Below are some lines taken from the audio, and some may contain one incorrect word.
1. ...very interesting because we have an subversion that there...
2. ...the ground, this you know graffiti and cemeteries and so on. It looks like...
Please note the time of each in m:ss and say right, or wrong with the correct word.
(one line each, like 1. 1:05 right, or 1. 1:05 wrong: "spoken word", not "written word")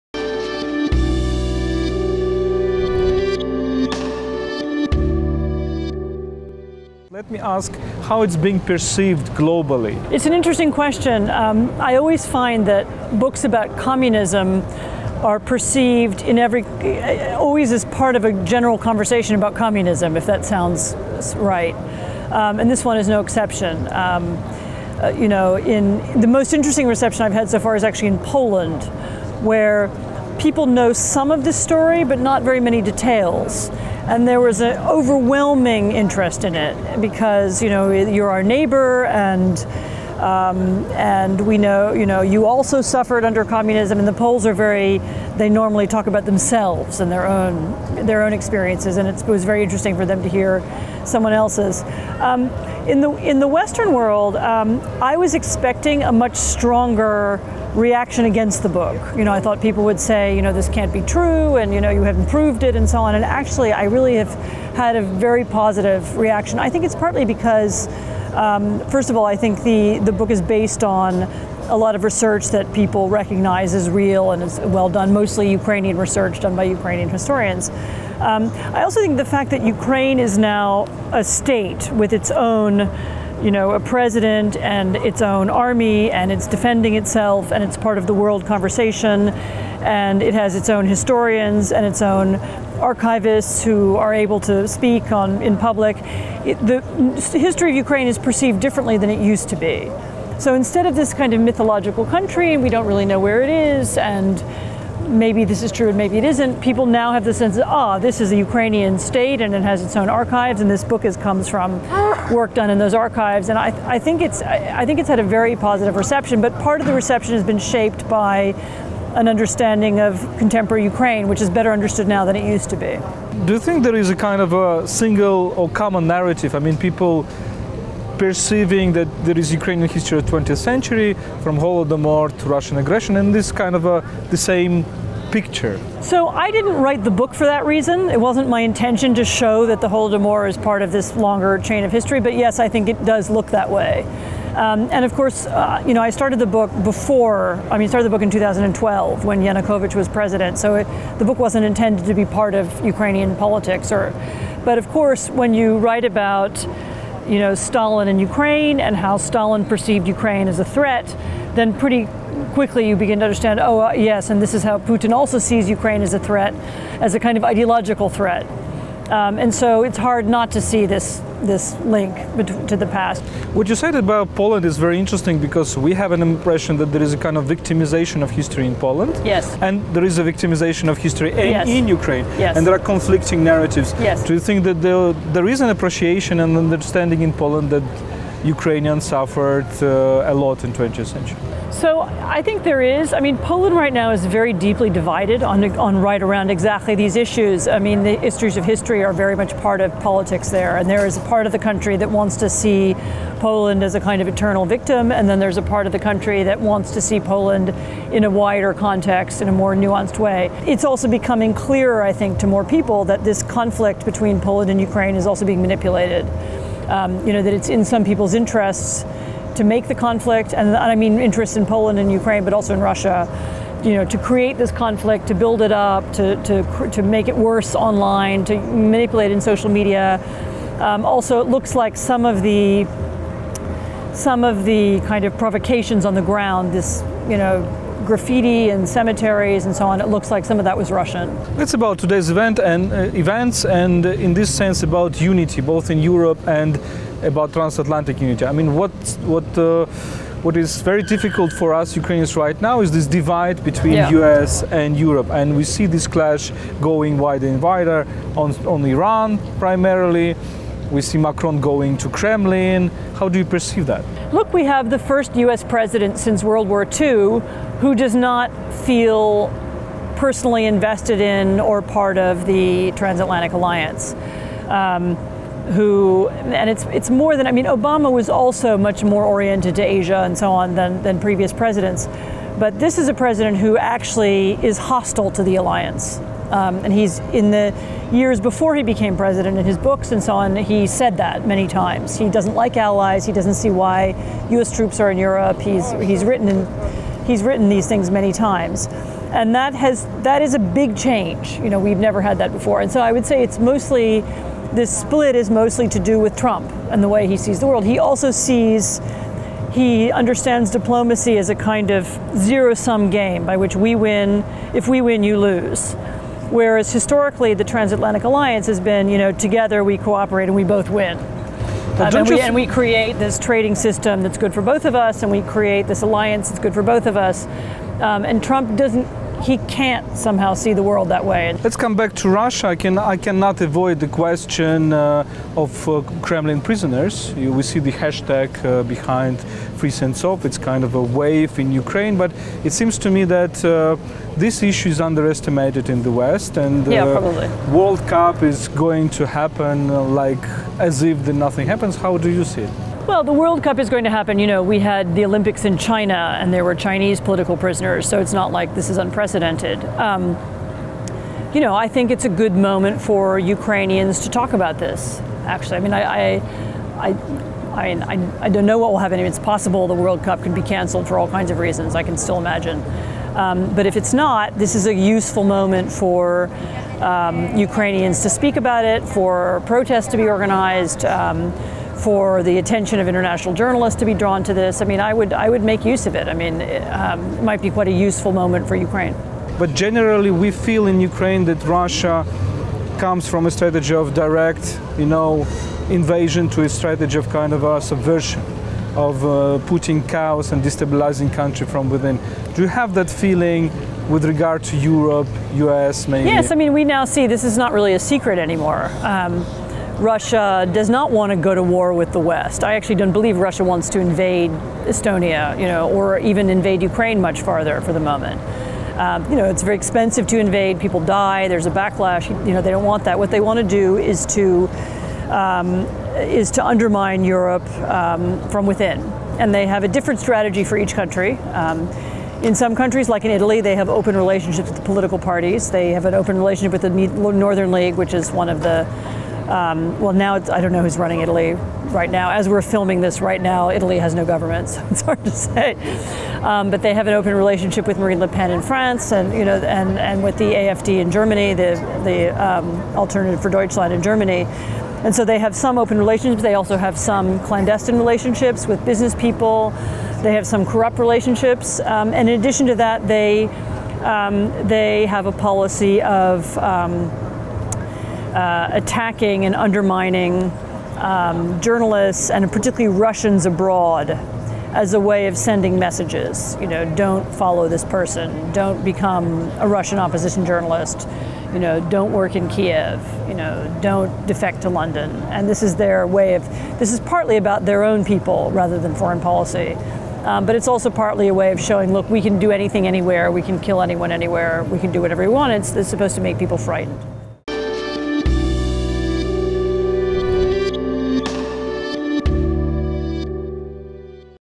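1. 2:54 wrong: "impression", not "subversion"
2. 3:56 right.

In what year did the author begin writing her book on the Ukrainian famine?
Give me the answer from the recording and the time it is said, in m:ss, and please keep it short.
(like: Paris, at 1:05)
2012, at 2:28.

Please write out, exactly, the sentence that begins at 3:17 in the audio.
I mean, the issues of history are very much part of politics there.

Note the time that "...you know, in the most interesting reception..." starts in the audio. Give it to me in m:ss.
0:25.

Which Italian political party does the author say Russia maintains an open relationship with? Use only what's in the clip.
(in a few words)
Northern League.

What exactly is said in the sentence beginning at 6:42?
Do you have that feeling with regard to Europe, US, maybe?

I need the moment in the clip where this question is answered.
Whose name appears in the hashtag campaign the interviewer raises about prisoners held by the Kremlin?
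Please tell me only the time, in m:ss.
5:39.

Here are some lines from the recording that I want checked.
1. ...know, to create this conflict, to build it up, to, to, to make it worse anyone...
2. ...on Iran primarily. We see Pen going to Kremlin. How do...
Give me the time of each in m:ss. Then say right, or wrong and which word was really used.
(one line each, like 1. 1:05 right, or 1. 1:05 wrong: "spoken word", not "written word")
1. 3:43 wrong: "online", not "anyone"
2. 4:18 wrong: "Macron", not "Pen".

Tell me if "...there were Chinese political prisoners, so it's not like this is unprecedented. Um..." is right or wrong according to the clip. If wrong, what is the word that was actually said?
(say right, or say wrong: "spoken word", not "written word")
right.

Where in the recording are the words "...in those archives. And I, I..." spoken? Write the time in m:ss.
1:52.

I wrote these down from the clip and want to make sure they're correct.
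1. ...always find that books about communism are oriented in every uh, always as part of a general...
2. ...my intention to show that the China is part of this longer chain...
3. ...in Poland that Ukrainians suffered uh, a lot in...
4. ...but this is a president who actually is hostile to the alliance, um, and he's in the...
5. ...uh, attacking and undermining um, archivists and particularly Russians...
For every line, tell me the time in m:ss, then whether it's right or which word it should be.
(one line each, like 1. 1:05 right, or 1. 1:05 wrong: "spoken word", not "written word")
1. 0:11 wrong: "perceived", not "oriented"
2. 2:18 wrong: "Holodomor", not "China"
3. 3:07 right
4. 4:42 right
5. 7:48 wrong: "journalists", not "archivists".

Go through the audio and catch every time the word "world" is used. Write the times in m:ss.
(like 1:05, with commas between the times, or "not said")
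0:53, 1:28, 4:26, 5:07, 5:30, 5:47, 5:53, 6:09.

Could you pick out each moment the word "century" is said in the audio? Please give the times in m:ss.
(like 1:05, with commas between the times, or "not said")
2:10, 3:11.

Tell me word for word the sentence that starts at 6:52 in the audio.
I actually don't believe Russia wants to invade Estonia, you know, or even invade Ukraine much farther for the moment.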